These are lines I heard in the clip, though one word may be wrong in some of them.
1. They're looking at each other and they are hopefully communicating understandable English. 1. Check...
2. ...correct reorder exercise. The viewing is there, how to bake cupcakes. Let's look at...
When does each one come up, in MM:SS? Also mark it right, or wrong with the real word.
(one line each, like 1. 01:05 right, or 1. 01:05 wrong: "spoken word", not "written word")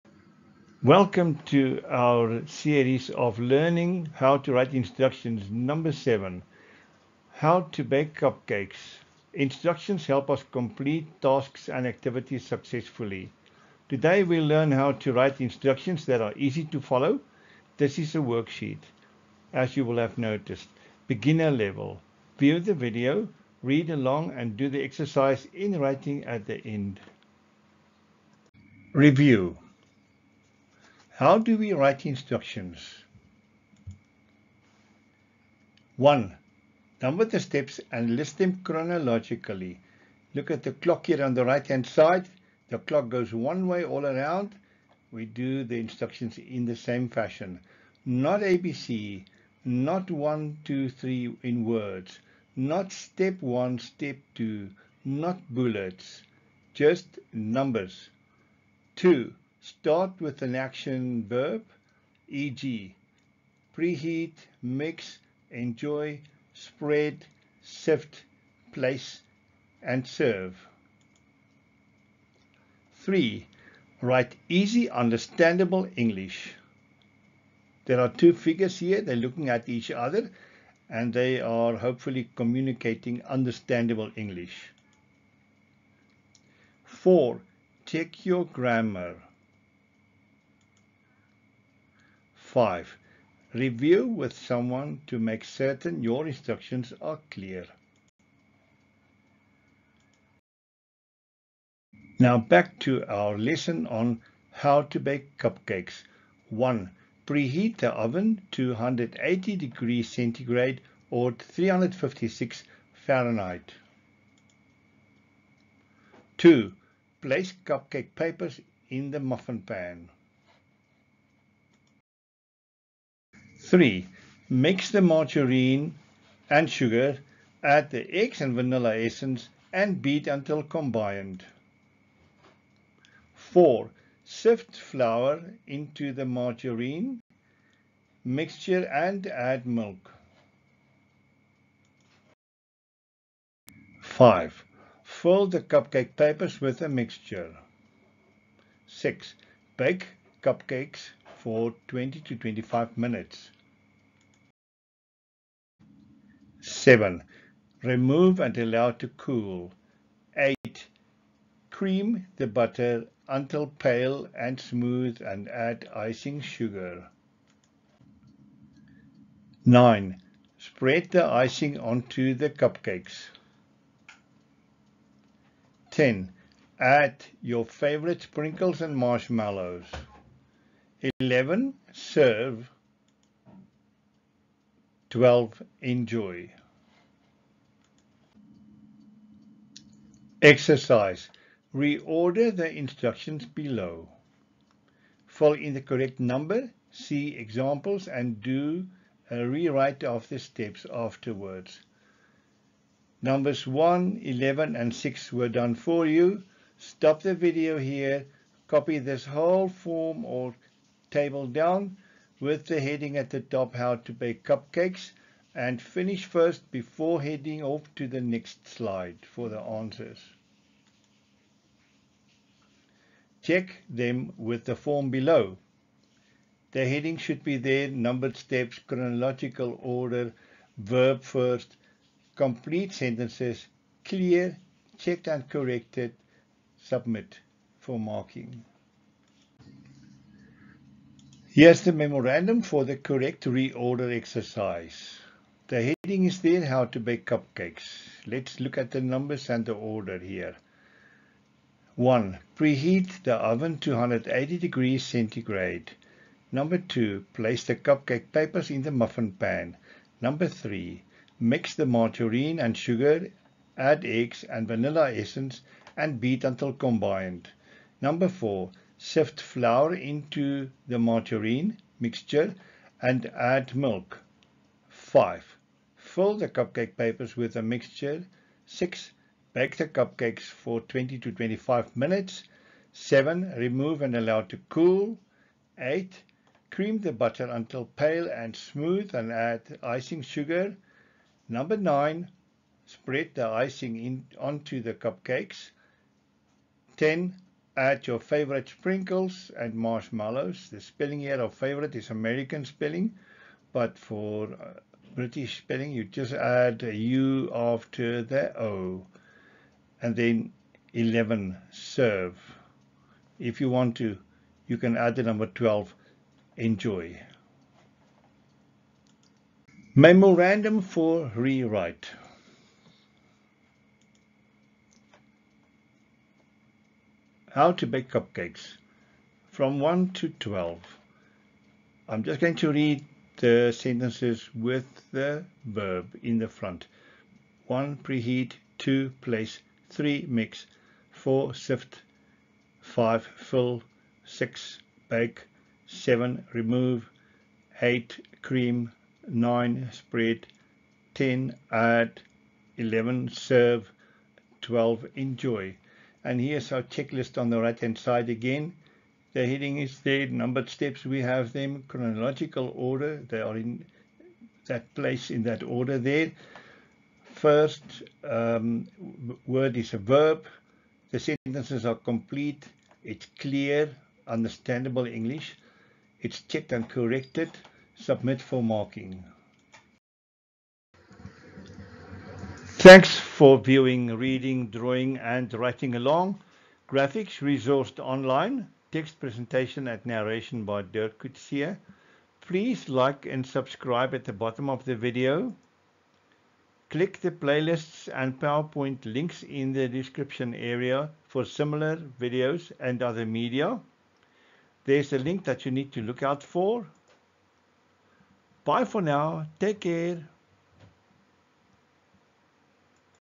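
1. 01:19 wrong: "4", not "1"
2. 04:02 wrong: "heading", not "viewing".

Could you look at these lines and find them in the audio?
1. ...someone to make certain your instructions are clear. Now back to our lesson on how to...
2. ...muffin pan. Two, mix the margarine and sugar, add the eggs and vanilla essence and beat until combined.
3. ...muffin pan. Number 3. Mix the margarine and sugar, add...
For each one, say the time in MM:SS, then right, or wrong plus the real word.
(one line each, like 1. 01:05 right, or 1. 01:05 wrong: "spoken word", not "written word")
1. 01:34 right
2. 01:59 wrong: "Three", not "Two"
3. 04:18 right.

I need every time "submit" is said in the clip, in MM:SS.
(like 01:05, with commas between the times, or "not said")
03:56, 06:17.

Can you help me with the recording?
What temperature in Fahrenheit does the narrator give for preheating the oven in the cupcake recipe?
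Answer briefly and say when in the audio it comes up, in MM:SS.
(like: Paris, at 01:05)
356 Fahrenheit, at 01:51.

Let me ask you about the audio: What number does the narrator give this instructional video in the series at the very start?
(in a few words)
7.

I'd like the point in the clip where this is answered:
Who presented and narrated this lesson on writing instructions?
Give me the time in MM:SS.
06:30.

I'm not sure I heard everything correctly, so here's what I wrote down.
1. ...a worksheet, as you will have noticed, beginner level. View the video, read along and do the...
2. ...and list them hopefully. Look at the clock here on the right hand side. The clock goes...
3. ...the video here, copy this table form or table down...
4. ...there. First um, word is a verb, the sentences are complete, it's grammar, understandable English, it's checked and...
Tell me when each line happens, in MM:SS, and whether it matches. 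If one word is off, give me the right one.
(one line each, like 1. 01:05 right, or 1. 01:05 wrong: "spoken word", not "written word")
1. 00:18 right
2. 00:37 wrong: "chronologically", not "hopefully"
3. 03:27 wrong: "whole", not "table"
4. 06:05 wrong: "clear", not "grammar".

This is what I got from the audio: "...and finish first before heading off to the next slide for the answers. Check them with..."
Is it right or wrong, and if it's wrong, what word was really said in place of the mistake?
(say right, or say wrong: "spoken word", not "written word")
right.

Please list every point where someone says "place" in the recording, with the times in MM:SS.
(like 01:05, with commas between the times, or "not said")
01:08, 01:57, 04:17, 05:39, 06:04.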